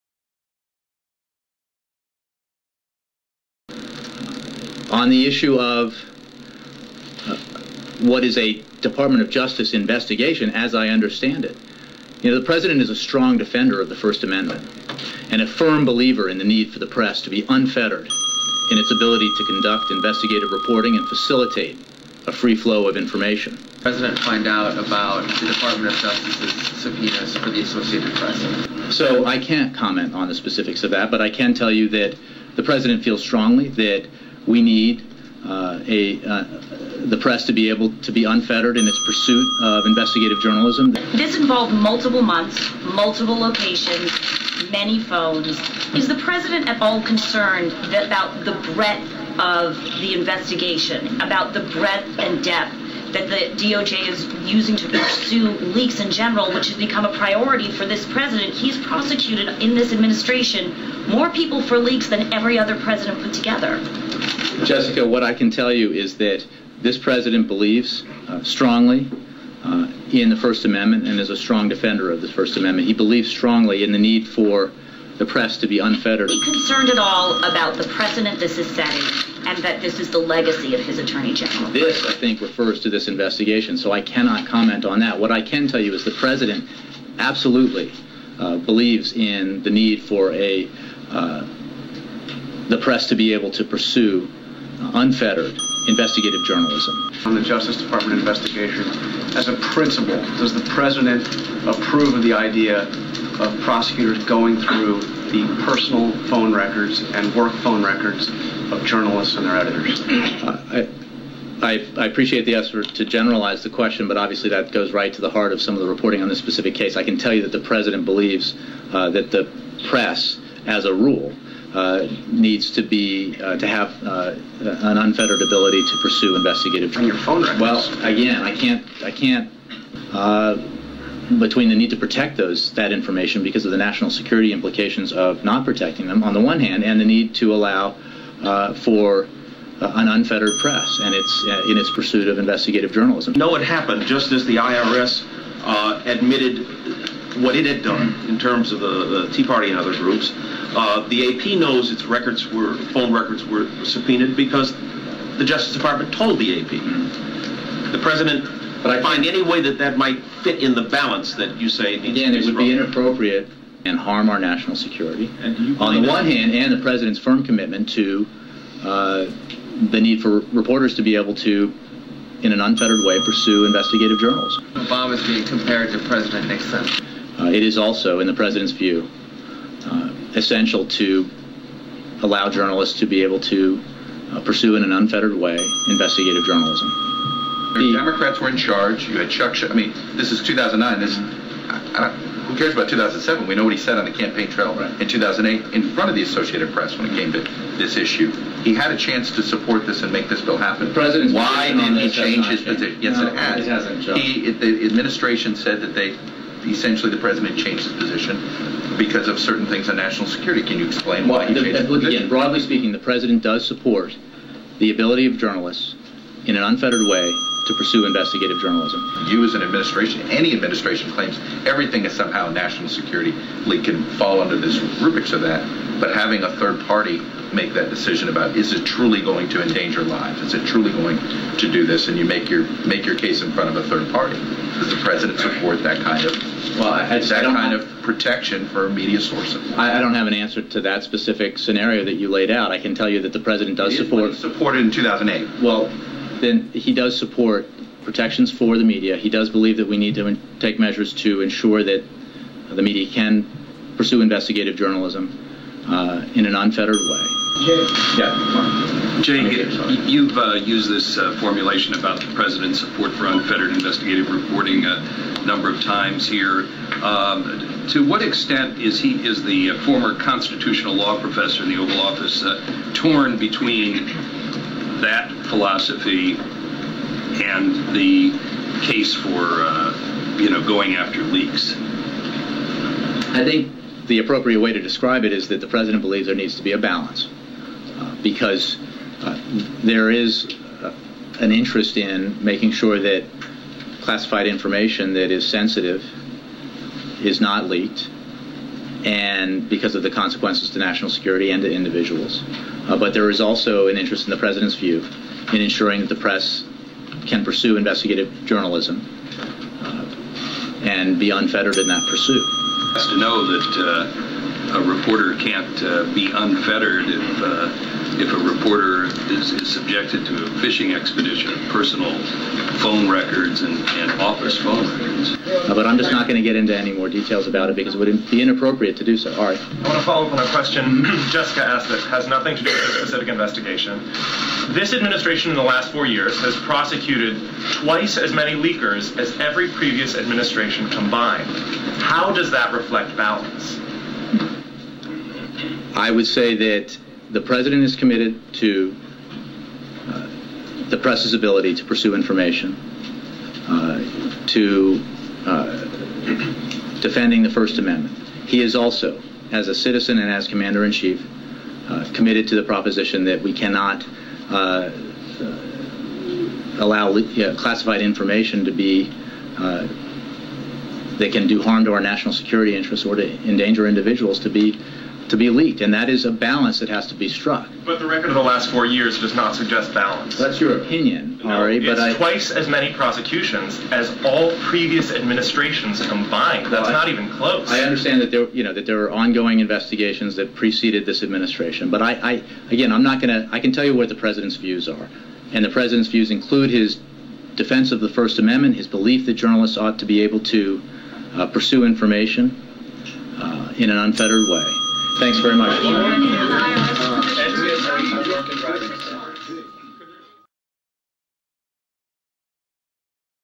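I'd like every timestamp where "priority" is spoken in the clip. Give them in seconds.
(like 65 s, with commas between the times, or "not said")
57 s.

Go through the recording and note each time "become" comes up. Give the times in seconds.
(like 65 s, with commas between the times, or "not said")
56 s.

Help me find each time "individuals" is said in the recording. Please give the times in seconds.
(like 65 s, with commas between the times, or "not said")
301 s, 373 s.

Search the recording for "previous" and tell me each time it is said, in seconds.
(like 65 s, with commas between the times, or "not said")
339 s, 384 s.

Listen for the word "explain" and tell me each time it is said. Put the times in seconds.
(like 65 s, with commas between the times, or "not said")
210 s.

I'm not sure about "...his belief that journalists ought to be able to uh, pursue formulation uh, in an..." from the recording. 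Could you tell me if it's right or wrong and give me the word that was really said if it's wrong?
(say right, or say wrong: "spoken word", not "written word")
wrong: "information", not "formulation".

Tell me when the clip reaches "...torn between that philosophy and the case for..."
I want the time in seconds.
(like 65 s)
272 s.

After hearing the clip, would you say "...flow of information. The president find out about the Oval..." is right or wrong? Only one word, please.
wrong.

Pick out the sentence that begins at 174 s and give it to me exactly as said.
Obama is being compared to President Nixon.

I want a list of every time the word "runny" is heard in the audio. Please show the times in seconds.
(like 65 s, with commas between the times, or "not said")
not said.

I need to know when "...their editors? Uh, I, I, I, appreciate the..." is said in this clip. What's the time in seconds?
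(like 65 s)
109 s.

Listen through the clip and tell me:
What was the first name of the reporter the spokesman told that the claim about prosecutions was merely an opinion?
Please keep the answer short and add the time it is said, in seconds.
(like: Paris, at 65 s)
Ari, at 381 s.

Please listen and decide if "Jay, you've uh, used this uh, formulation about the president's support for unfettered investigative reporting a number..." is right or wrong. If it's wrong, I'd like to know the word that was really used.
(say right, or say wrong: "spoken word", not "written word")
right.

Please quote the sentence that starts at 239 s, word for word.
I, I, don't have an answer to that specific scenario that you laid out.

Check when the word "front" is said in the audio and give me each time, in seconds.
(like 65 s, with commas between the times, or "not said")
195 s, 233 s.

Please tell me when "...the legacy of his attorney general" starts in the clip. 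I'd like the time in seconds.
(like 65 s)
80 s.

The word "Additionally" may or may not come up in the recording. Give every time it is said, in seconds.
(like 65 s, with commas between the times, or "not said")
not said.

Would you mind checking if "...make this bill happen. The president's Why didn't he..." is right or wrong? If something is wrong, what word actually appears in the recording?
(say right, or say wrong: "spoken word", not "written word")
right.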